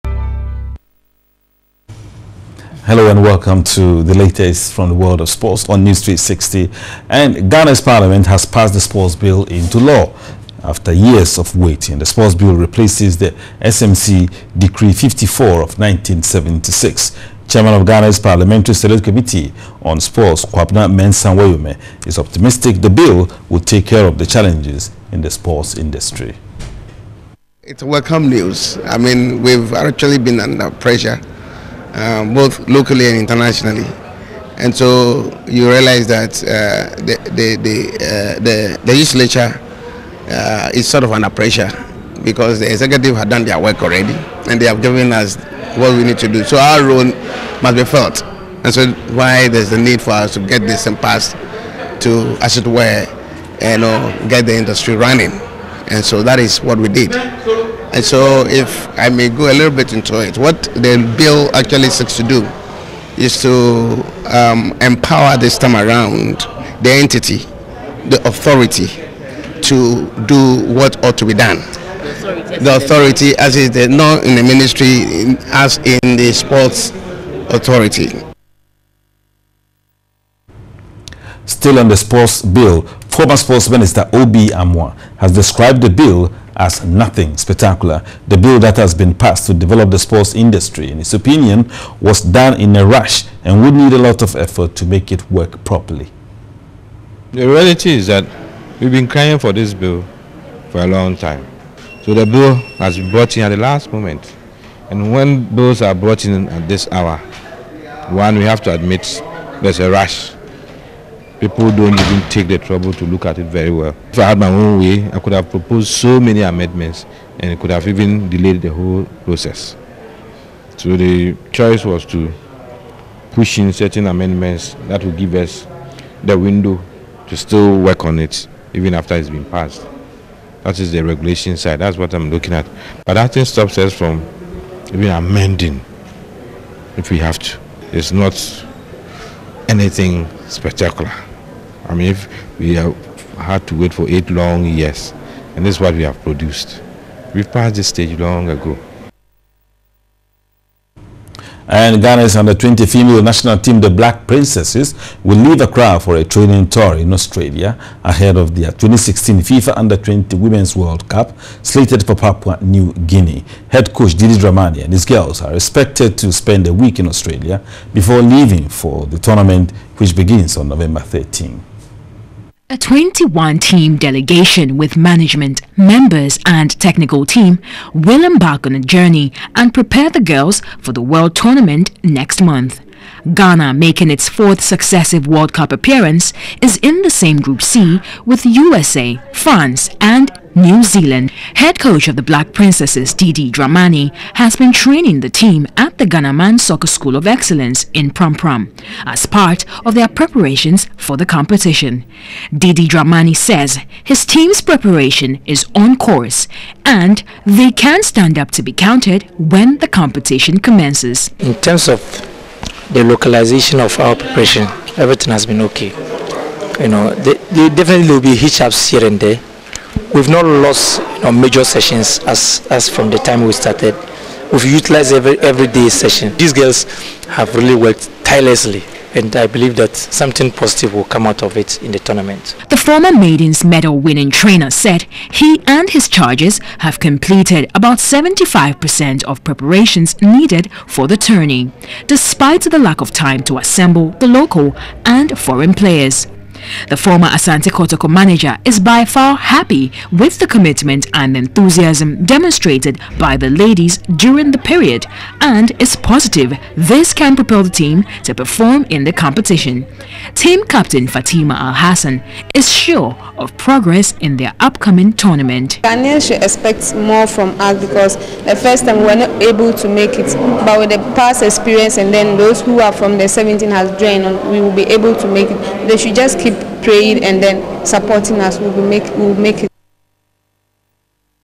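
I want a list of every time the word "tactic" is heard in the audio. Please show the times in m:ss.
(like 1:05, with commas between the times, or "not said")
not said.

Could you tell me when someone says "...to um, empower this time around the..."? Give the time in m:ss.
1:03.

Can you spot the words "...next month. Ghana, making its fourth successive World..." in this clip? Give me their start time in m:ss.
3:02.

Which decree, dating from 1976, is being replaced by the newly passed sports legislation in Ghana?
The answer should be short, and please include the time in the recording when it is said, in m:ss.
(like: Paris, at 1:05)
SMC Decree 54, at 0:13.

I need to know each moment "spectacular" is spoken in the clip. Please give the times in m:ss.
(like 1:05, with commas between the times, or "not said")
1:27, 2:20.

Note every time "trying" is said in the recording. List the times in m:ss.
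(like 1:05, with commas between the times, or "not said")
not said.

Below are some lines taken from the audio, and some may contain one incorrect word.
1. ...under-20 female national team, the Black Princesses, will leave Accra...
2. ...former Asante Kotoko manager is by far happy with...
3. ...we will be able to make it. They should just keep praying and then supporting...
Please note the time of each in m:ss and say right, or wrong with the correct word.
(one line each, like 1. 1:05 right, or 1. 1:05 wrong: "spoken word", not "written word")
1. 2:32 right
2. 4:06 right
3. 4:34 right.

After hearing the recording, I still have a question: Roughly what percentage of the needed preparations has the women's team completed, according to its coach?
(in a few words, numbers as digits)
75%.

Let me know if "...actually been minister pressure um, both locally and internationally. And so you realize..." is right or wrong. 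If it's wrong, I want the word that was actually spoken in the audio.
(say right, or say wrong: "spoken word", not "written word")
wrong: "under", not "minister".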